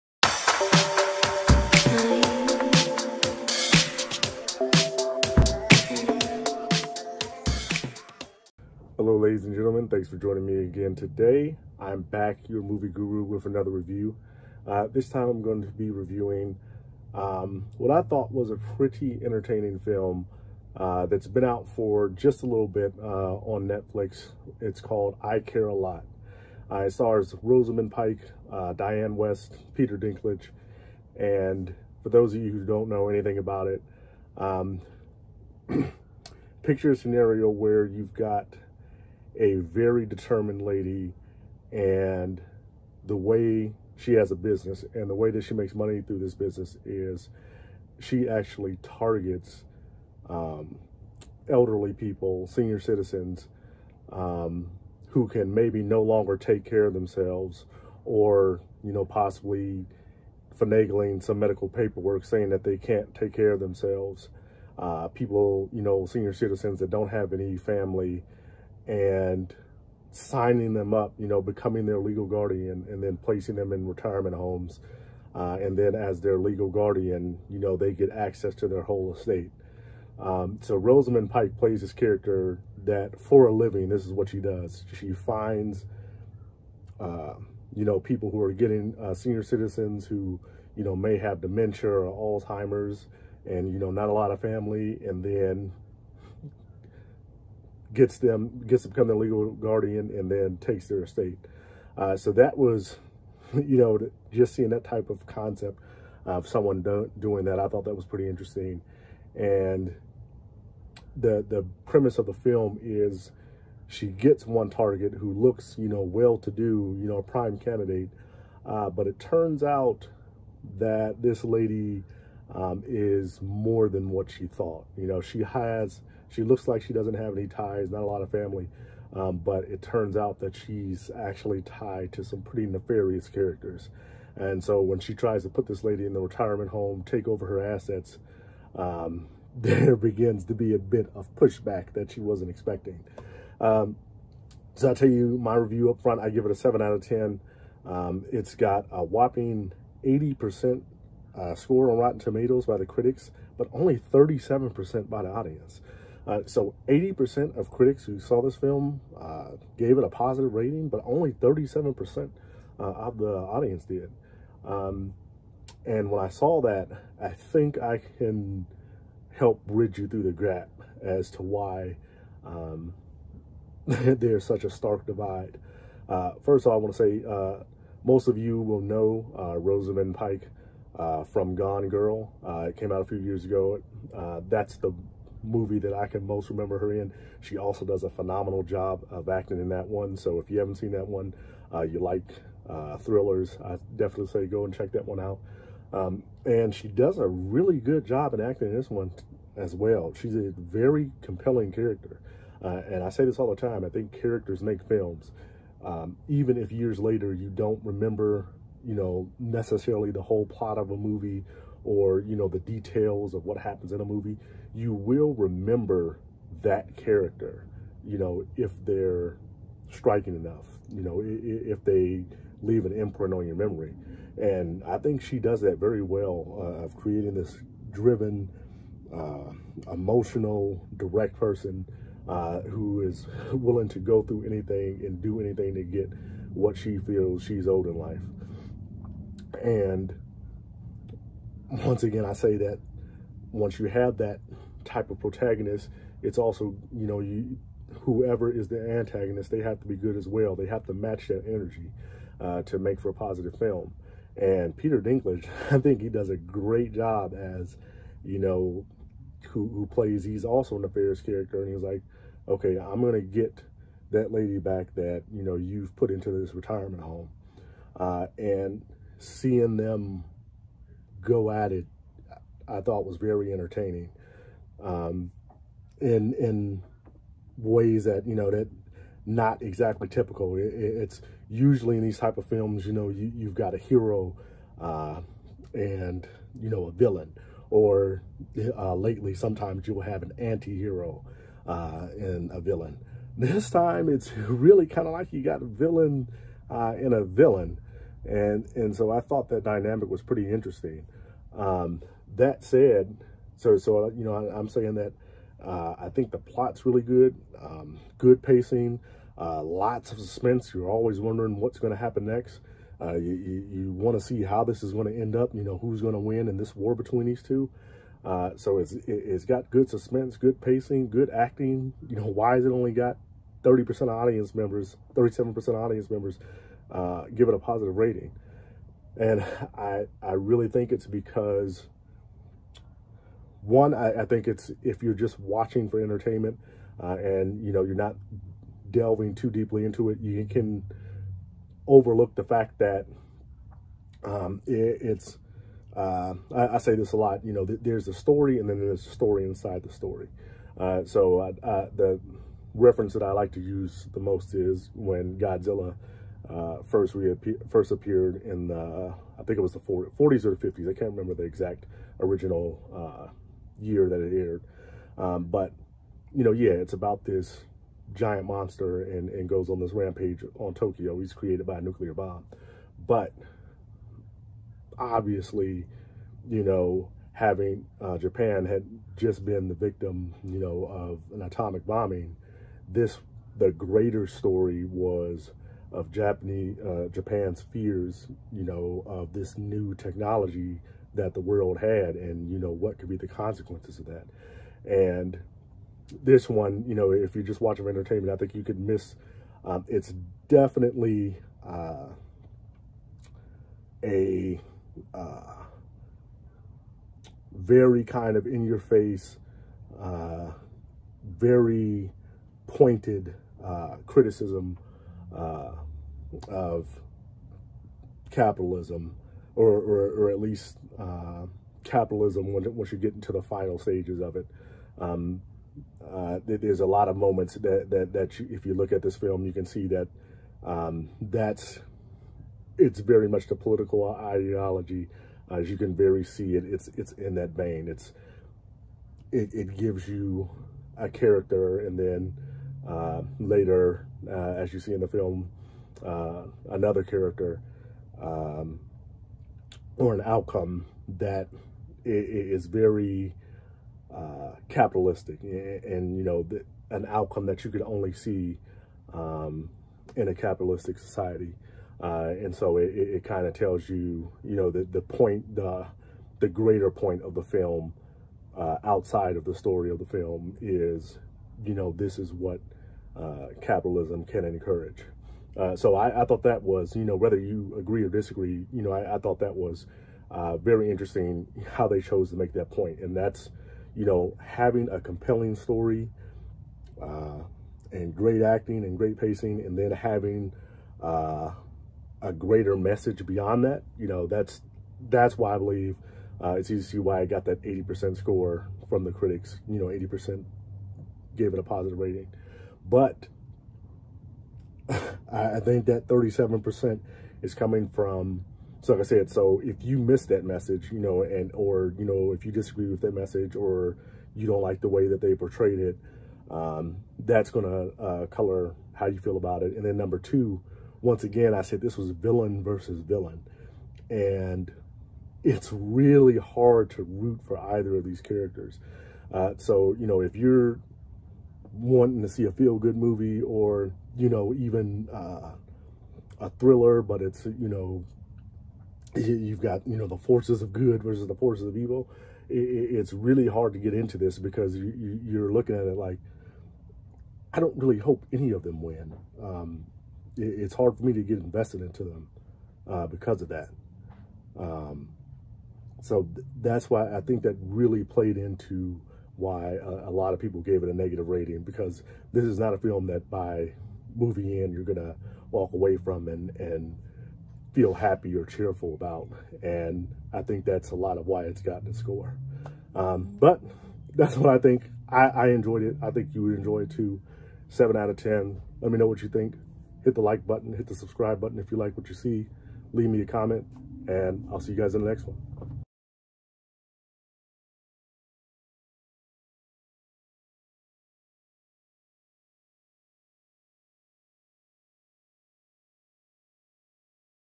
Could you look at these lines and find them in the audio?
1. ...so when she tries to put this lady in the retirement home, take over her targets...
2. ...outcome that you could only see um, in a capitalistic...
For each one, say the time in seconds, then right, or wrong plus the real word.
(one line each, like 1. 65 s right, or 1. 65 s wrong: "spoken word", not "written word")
1. 134 s wrong: "assets", not "targets"
2. 457 s right.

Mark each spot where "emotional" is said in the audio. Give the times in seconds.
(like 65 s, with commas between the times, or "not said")
229 s.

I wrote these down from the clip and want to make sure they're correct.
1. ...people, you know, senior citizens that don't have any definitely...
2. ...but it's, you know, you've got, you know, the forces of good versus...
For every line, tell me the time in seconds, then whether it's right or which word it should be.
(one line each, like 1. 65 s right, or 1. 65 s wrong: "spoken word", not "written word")
1. 65 s wrong: "family", not "definitely"
2. 537 s right.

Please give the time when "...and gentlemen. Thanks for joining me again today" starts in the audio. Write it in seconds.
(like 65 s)
9 s.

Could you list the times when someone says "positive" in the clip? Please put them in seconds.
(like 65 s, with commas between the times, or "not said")
160 s, 253 s, 327 s, 501 s.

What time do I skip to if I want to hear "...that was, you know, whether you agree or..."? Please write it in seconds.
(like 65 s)
476 s.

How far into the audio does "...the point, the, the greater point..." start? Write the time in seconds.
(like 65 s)
464 s.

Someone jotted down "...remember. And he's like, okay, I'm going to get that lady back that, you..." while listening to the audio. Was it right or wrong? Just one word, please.
wrong.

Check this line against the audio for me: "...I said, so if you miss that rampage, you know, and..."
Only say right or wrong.
wrong.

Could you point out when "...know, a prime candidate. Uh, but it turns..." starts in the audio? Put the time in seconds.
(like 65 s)
117 s.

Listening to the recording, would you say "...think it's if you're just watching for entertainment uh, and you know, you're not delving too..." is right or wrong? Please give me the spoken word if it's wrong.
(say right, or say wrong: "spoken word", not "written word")
right.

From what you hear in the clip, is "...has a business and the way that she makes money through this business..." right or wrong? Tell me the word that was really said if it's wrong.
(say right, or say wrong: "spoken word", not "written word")
right.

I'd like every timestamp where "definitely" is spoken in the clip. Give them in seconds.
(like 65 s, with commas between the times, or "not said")
193 s, 400 s.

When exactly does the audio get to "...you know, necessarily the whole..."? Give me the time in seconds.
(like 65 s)
208 s.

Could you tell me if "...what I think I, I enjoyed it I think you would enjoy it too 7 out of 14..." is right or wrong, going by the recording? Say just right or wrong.
wrong.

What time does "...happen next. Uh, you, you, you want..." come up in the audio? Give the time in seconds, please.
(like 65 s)
311 s.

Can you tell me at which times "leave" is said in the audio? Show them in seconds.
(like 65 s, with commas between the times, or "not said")
222 s, 582 s.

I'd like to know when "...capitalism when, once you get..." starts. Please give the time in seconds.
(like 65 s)
421 s.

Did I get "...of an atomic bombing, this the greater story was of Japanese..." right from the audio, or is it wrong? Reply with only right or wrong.
right.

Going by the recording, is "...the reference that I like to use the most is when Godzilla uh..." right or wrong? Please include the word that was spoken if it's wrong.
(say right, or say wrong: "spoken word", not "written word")
right.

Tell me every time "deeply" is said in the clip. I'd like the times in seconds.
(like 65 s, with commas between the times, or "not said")
339 s.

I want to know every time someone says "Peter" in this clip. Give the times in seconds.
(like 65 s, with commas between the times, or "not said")
29 s, 254 s.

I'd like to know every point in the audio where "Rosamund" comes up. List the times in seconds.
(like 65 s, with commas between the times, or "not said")
27 s, 80 s, 179 s.